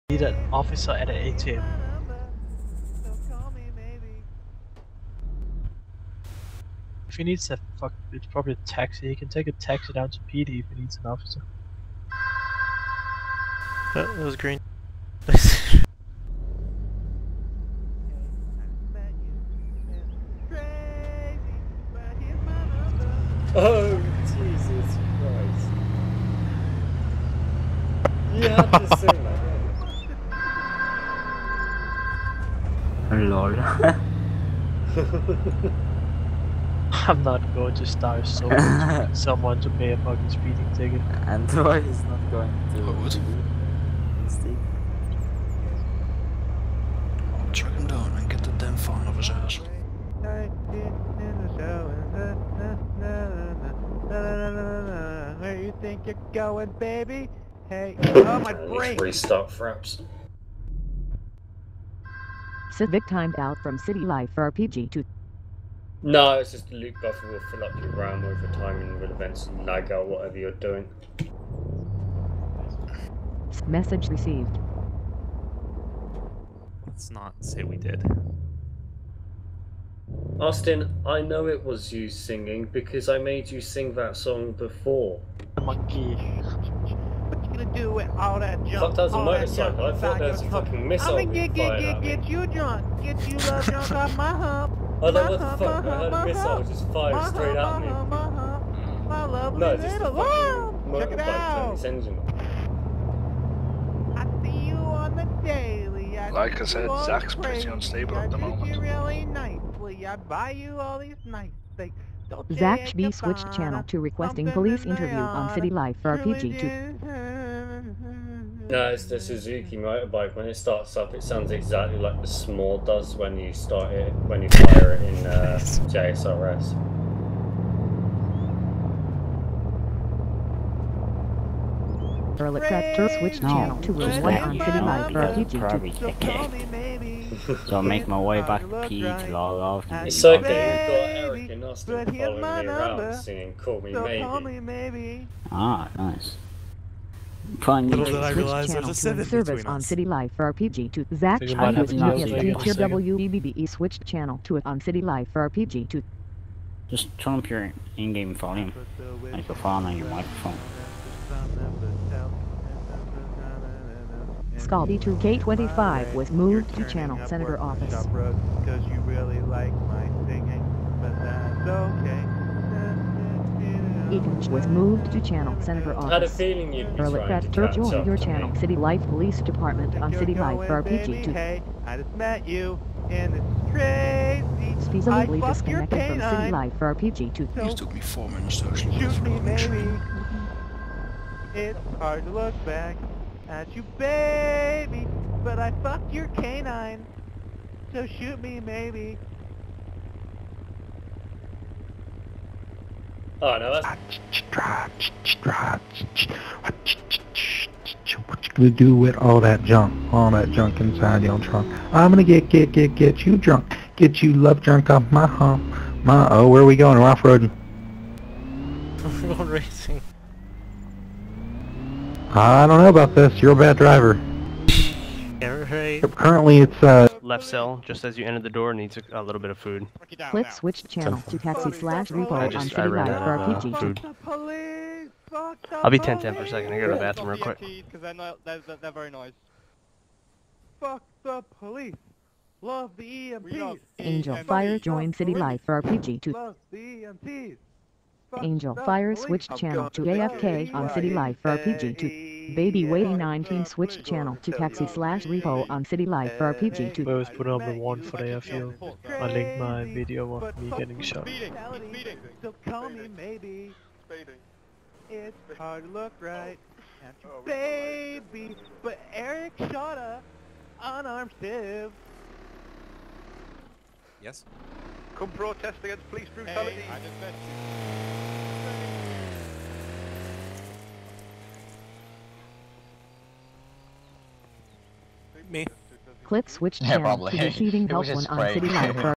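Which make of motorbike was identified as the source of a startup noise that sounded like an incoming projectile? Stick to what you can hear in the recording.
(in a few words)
Suzuki.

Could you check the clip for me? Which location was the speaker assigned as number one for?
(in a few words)
the airfield.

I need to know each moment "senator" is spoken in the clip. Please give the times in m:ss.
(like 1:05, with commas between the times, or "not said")
2:47, 2:55.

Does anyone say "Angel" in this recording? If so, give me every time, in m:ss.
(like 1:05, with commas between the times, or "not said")
4:03, 4:08.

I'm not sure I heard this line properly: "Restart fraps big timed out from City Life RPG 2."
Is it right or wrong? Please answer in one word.
right.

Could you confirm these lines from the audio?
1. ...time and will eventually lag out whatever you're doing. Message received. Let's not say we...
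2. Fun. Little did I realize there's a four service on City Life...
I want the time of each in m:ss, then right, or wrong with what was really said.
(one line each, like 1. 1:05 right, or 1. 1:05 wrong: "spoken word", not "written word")
1. 1:08 right
2. 2:27 wrong: "seven", not "four".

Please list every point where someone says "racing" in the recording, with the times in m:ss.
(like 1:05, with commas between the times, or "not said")
3:39.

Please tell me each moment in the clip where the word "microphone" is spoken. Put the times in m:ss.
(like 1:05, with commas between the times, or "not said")
2:40.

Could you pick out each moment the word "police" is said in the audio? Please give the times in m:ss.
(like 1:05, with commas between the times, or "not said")
1:54, 2:59, 4:01, 4:36.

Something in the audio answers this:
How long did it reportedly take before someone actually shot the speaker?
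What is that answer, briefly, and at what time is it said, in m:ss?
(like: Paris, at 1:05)
4 minutes, at 3:08.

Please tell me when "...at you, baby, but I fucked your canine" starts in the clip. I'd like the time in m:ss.
3:13.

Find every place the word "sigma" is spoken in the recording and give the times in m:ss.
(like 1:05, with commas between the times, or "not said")
not said.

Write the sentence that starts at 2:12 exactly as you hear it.
Charlotte Tractor switch channel to 1 on City Light for PG2.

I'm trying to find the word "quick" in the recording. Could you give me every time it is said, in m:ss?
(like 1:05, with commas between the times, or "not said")
3:57.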